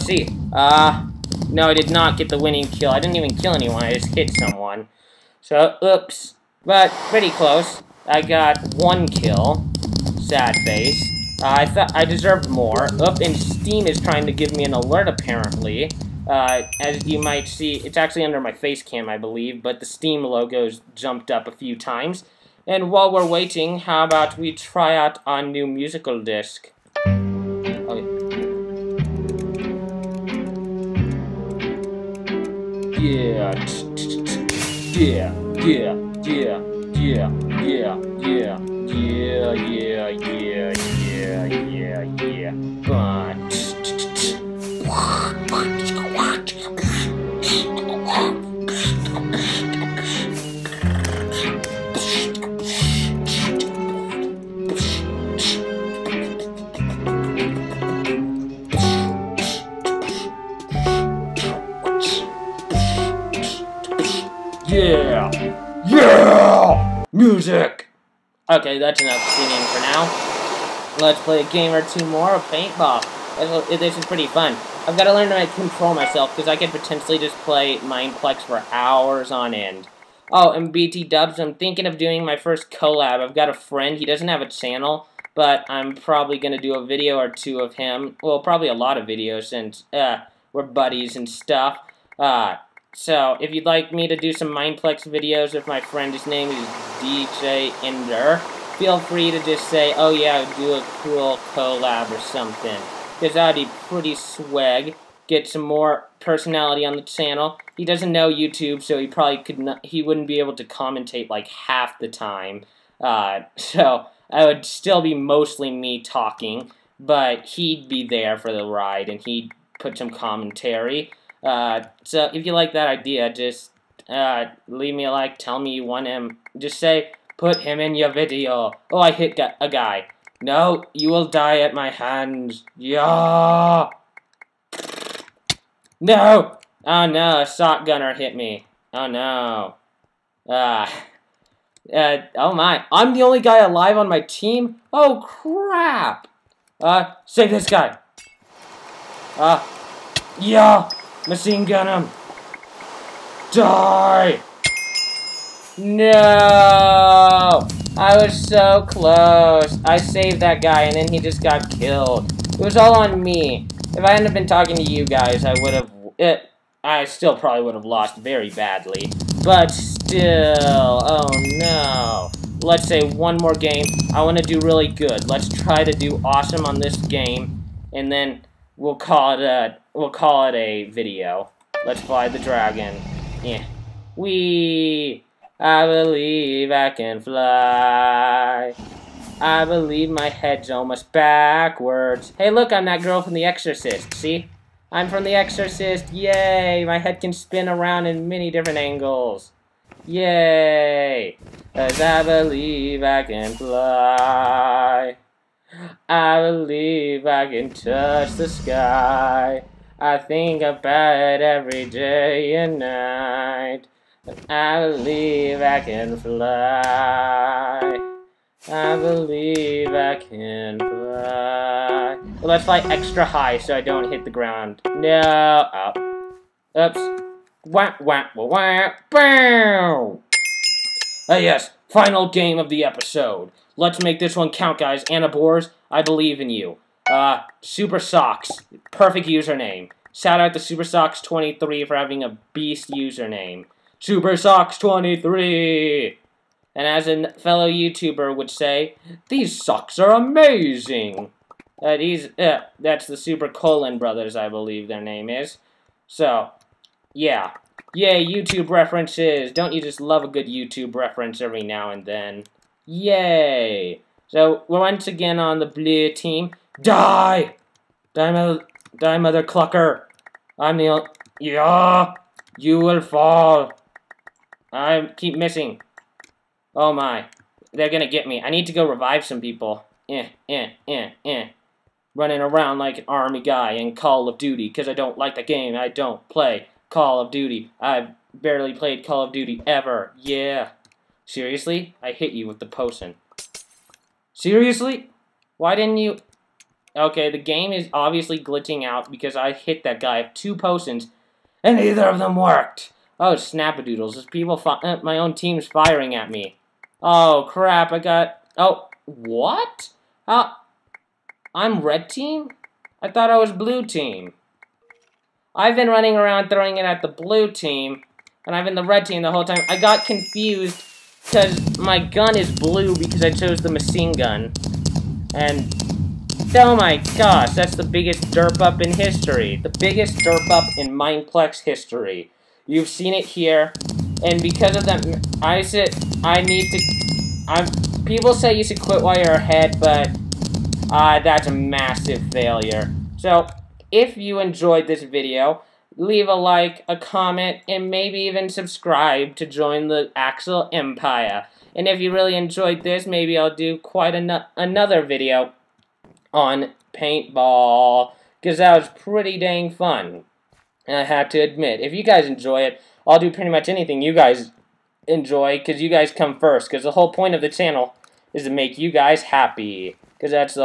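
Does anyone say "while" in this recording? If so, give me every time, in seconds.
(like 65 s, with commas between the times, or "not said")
22 s, 339 s.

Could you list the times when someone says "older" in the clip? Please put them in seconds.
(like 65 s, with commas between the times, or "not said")
not said.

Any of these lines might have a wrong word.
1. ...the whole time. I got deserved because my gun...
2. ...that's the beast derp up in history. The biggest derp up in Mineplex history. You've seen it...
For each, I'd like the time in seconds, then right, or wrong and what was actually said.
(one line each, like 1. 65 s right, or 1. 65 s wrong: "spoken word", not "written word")
1. 319 s wrong: "confused", not "deserved"
2. 327 s wrong: "biggest", not "beast".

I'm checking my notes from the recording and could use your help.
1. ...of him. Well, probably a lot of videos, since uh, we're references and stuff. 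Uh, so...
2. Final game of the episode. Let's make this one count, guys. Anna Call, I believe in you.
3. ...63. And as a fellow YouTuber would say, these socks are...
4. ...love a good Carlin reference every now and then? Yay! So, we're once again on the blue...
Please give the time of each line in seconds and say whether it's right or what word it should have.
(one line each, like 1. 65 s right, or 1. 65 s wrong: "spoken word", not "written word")
1. 87 s wrong: "buddies", not "references"
2. 231 s wrong: "Boers", not "Call"
3. 244 s wrong: "23", not "63"
4. 259 s wrong: "YouTube", not "Carlin".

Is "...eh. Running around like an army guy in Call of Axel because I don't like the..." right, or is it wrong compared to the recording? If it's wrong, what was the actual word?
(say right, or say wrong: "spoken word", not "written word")
wrong: "Duty", not "Axel".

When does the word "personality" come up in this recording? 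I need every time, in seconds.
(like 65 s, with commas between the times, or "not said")
106 s.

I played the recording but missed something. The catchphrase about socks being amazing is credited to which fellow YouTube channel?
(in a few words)
Super Carlin Brothers.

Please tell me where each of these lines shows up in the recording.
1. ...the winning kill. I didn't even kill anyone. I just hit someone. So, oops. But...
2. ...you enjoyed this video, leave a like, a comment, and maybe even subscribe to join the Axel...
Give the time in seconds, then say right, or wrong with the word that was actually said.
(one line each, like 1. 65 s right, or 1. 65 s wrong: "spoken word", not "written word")
1. 2 s right
2. 344 s right.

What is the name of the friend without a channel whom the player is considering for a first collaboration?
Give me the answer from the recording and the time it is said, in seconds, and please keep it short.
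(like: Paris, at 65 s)
DJ Ender, at 96 s.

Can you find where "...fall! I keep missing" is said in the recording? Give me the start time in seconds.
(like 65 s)
273 s.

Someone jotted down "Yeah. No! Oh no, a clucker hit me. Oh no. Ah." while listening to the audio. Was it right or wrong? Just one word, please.
wrong.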